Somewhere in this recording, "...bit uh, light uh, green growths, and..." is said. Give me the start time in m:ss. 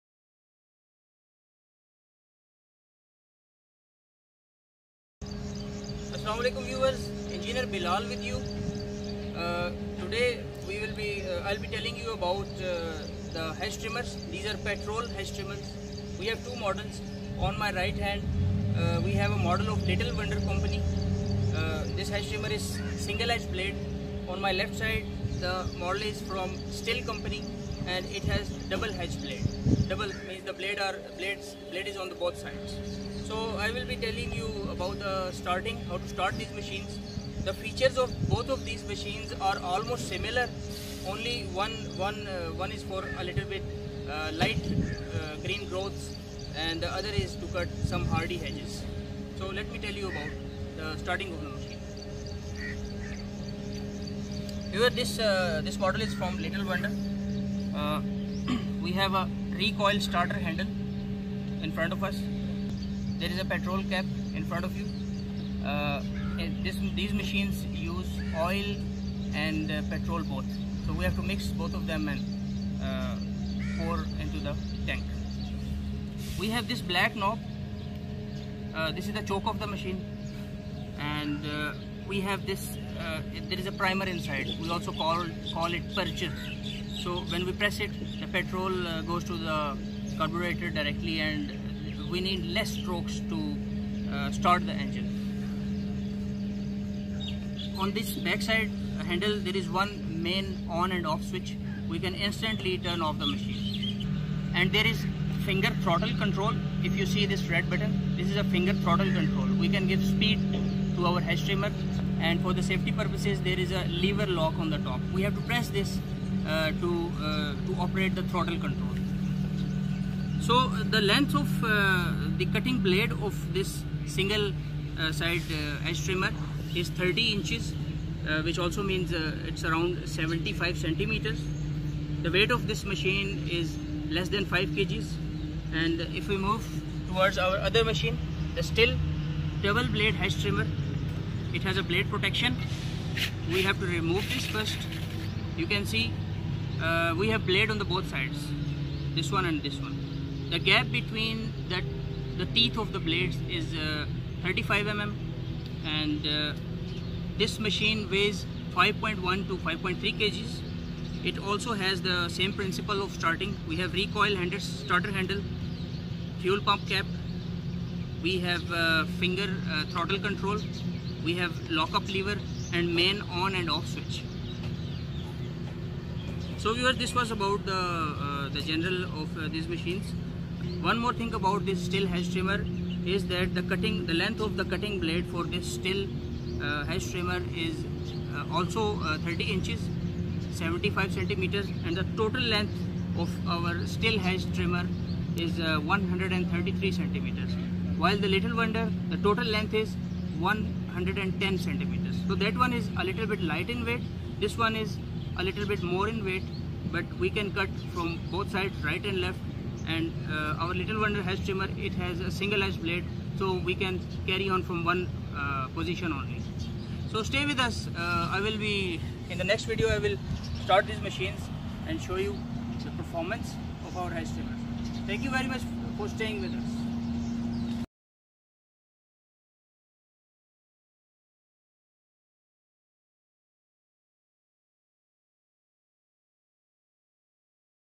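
0:43.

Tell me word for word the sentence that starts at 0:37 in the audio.
The features of both of these machines are almost similar.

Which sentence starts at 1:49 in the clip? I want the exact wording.
We can give speed to our head trimmer and for the safety purposes there is a lever lock on the top.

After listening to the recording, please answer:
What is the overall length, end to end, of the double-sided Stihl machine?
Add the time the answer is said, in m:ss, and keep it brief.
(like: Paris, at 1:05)
133 centimeters, at 3:15.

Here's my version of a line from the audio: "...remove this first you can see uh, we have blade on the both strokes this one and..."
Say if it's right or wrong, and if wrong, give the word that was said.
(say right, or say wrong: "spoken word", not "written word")
wrong: "sides", not "strokes".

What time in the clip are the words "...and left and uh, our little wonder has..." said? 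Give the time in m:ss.
3:29.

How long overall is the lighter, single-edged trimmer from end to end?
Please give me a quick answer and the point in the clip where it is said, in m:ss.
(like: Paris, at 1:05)
110 centimeters, at 3:20.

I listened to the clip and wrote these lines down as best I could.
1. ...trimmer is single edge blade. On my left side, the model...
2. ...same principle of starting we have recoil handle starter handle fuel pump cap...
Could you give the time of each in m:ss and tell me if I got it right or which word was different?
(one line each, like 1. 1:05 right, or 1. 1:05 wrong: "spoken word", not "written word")
1. 0:22 right
2. 2:42 right.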